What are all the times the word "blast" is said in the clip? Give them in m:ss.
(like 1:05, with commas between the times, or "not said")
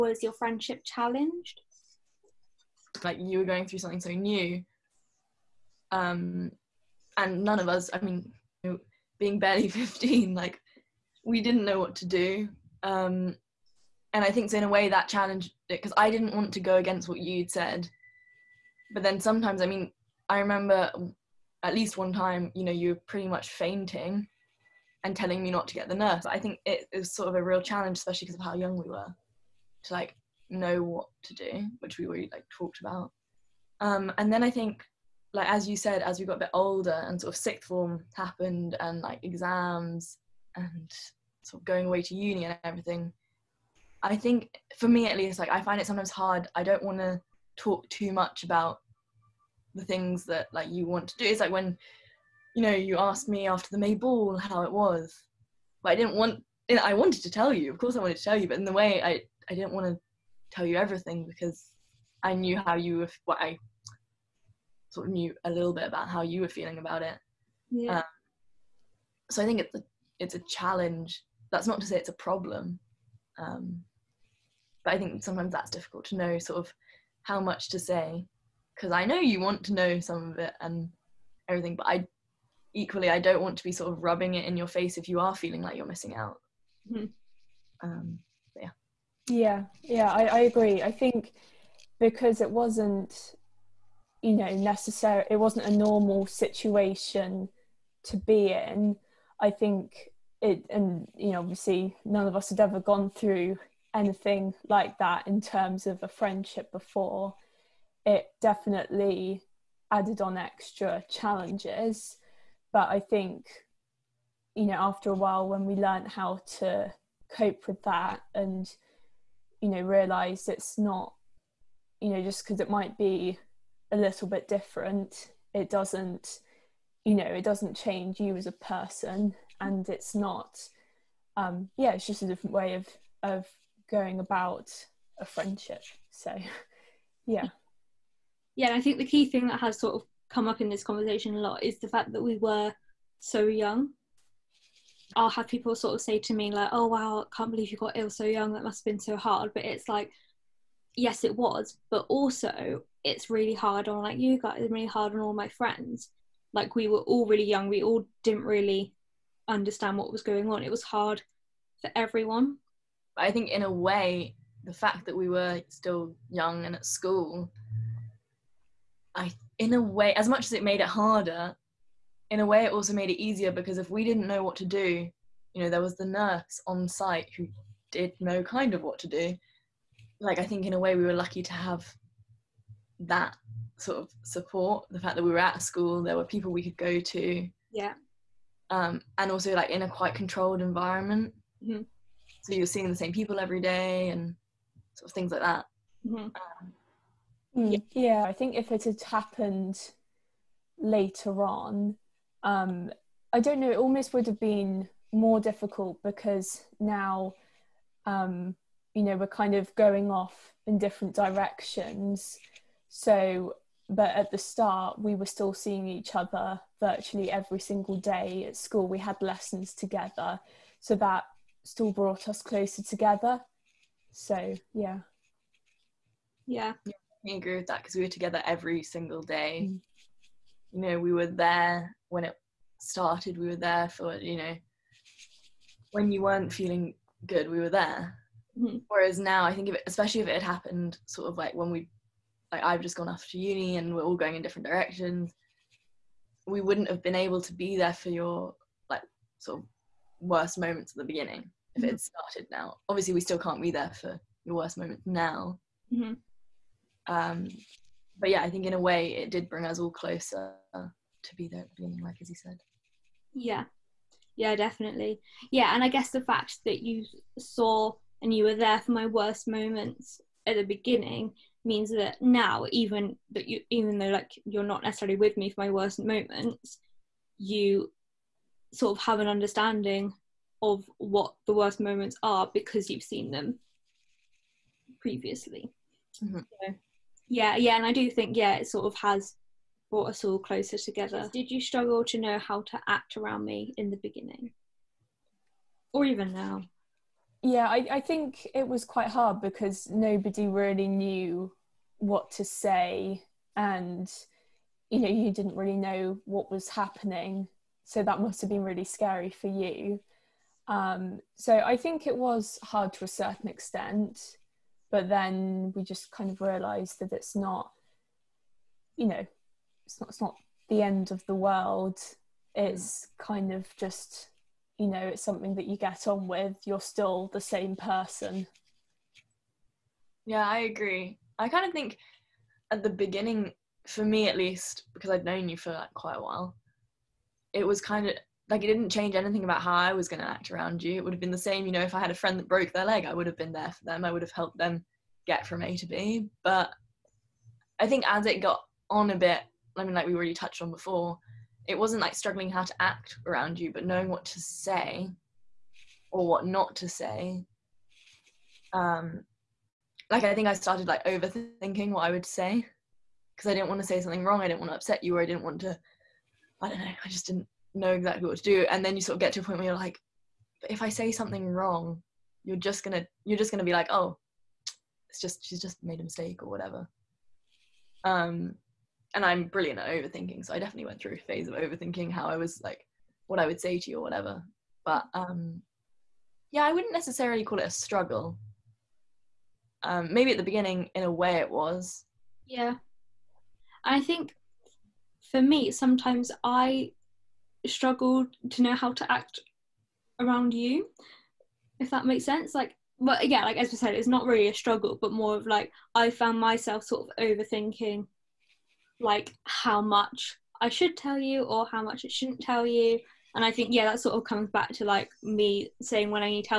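not said.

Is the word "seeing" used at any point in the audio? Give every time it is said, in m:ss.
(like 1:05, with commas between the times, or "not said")
3:12, 3:35.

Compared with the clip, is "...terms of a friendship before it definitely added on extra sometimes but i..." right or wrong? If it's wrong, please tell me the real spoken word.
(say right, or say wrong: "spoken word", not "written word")
wrong: "challenges", not "sometimes".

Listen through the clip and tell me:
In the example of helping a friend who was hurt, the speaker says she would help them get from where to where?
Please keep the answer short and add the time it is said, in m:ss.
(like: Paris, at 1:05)
A to B, at 5:45.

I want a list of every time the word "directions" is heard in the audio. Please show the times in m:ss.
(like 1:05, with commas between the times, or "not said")
3:31, 4:04.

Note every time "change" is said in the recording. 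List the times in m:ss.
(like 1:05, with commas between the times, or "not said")
2:07, 5:38.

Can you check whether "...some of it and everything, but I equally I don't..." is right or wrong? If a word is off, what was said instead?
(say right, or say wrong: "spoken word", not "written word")
right.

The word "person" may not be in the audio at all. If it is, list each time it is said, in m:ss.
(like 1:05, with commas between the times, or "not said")
2:08, 5:27.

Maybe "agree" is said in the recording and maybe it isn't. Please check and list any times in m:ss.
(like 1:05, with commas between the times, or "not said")
1:30, 3:47, 5:30.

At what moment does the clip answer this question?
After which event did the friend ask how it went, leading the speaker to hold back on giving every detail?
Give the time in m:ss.
0:53.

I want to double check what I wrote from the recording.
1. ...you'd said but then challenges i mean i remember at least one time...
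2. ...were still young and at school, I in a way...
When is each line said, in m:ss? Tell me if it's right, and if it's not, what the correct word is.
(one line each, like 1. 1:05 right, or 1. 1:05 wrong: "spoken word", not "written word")
1. 0:17 wrong: "sometimes", not "challenges"
2. 2:45 right.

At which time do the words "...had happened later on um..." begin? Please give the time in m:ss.
3:18.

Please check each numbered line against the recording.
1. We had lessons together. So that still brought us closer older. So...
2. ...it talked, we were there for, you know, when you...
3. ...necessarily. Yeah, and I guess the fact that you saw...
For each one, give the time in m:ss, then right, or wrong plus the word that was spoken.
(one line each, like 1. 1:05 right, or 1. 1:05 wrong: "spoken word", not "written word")
1. 3:38 wrong: "together", not "older"
2. 3:52 wrong: "started", not "talked"
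3. 4:24 wrong: "definitely", not "necessarily".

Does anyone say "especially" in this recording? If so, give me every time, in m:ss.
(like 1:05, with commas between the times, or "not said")
0:27, 3:59.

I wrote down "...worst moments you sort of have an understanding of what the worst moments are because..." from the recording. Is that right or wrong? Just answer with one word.
right.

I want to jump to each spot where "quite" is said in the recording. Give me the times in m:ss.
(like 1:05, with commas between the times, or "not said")
3:09, 4:58, 5:35.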